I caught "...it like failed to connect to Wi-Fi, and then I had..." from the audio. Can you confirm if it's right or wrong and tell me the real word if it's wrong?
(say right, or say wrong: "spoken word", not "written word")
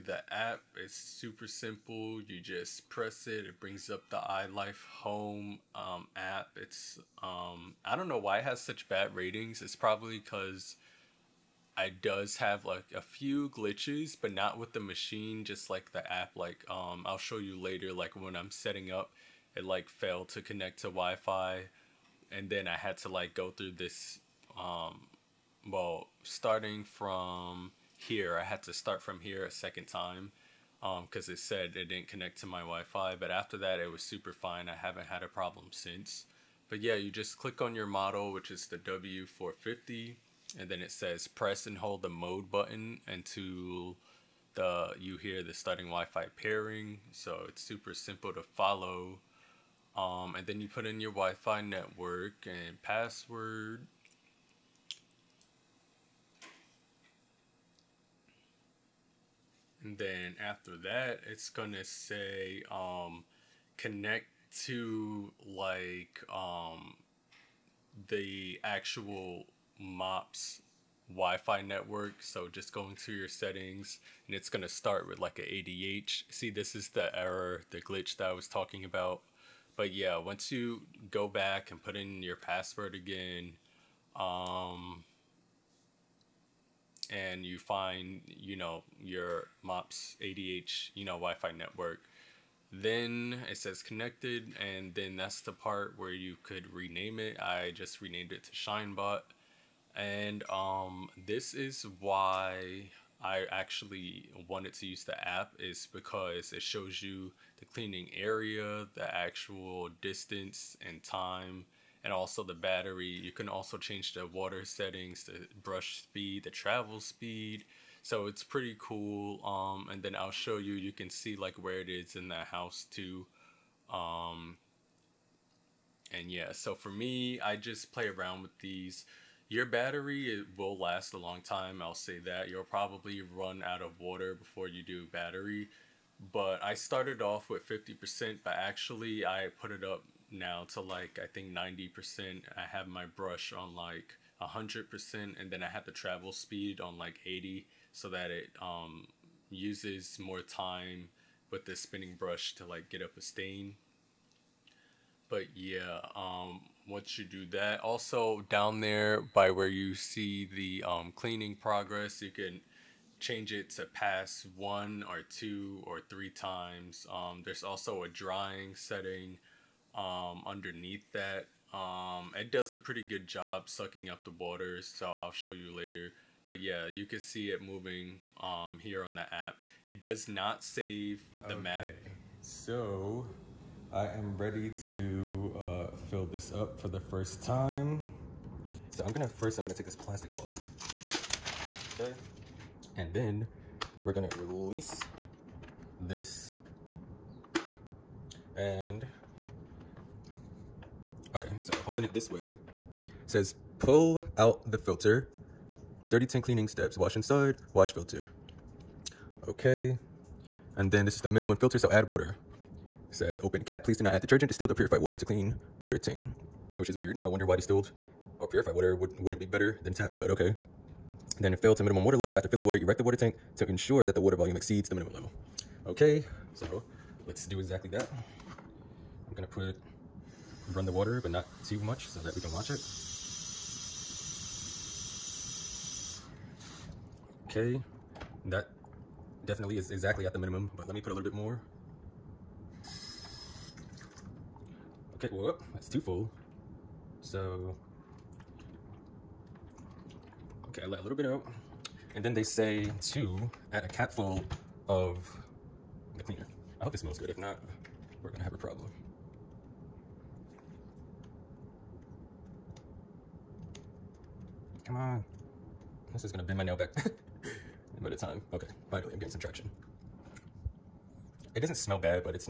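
right.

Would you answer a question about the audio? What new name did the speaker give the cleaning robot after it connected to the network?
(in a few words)
Shinebot.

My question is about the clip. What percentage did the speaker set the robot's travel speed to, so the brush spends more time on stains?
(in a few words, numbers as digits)
80.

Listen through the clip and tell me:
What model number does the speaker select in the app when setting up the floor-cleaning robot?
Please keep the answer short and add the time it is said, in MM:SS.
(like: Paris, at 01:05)
W450, at 00:38.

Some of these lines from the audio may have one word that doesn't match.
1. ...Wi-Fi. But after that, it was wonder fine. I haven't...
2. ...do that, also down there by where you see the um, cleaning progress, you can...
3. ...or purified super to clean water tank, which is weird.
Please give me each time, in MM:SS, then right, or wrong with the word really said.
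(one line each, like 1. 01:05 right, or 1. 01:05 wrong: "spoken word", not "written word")
1. 00:32 wrong: "super", not "wonder"
2. 02:37 right
3. 03:34 wrong: "water", not "super".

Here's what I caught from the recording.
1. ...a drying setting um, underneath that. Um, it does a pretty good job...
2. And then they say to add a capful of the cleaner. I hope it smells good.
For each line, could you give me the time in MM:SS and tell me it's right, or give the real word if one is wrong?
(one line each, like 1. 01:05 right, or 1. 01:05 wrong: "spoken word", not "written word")
1. 02:48 right
2. 04:12 right.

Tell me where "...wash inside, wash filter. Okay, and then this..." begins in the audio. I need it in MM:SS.
03:26.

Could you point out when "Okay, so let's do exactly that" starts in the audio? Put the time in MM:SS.
03:45.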